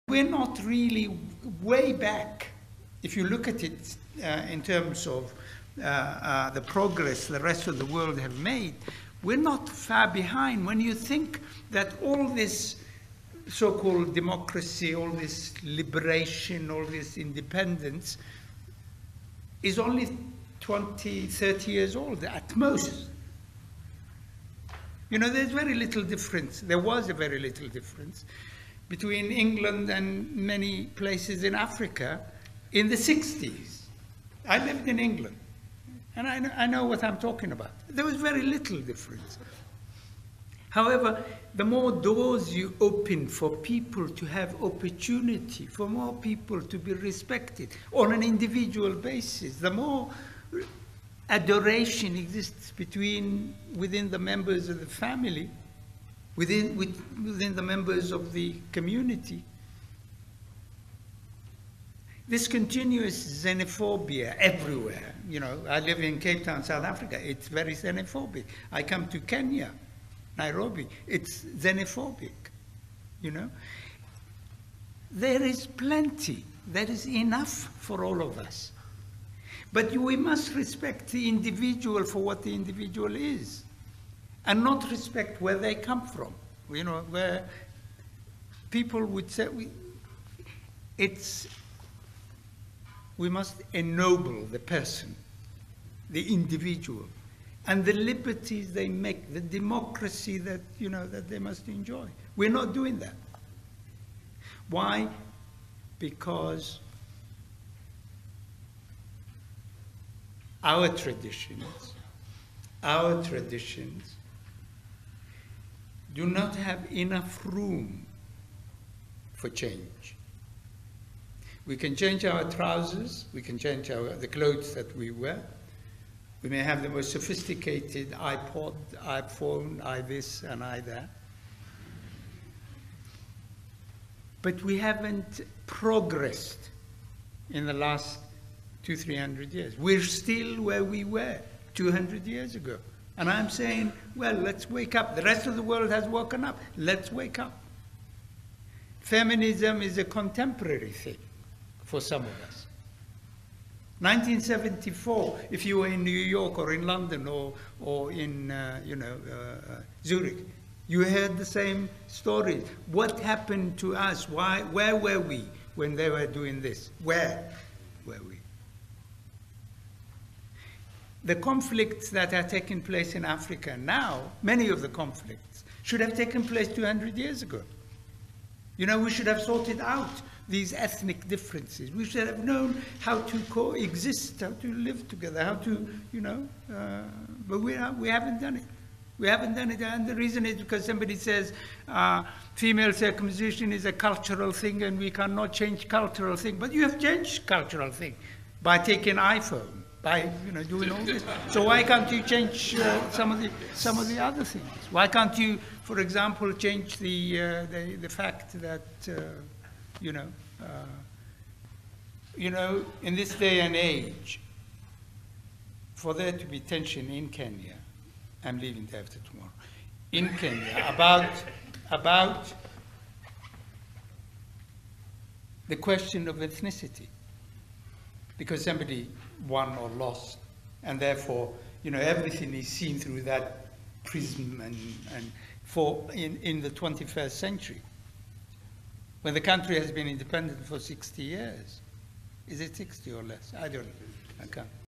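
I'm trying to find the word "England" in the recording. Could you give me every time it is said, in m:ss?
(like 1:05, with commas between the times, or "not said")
0:29, 0:34.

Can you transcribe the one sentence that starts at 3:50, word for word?
And therefore, you know, everything is seen through that prism and, and for in, in the 21st century.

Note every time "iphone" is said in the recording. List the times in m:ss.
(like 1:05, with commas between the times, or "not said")
2:09, 3:19.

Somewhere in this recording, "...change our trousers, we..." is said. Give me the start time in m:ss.
2:01.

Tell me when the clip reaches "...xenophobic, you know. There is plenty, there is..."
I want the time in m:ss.
1:11.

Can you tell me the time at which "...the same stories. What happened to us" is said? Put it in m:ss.
2:41.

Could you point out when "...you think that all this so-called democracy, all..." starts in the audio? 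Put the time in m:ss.
0:10.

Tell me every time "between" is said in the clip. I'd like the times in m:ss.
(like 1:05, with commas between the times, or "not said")
0:28, 0:52.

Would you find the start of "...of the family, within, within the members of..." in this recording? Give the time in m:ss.
0:54.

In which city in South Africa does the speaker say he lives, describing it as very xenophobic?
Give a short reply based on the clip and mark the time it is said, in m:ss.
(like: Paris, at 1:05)
Cape Town, at 1:06.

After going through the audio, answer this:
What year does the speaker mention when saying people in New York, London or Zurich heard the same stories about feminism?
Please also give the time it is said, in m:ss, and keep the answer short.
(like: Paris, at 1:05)
1974, at 2:33.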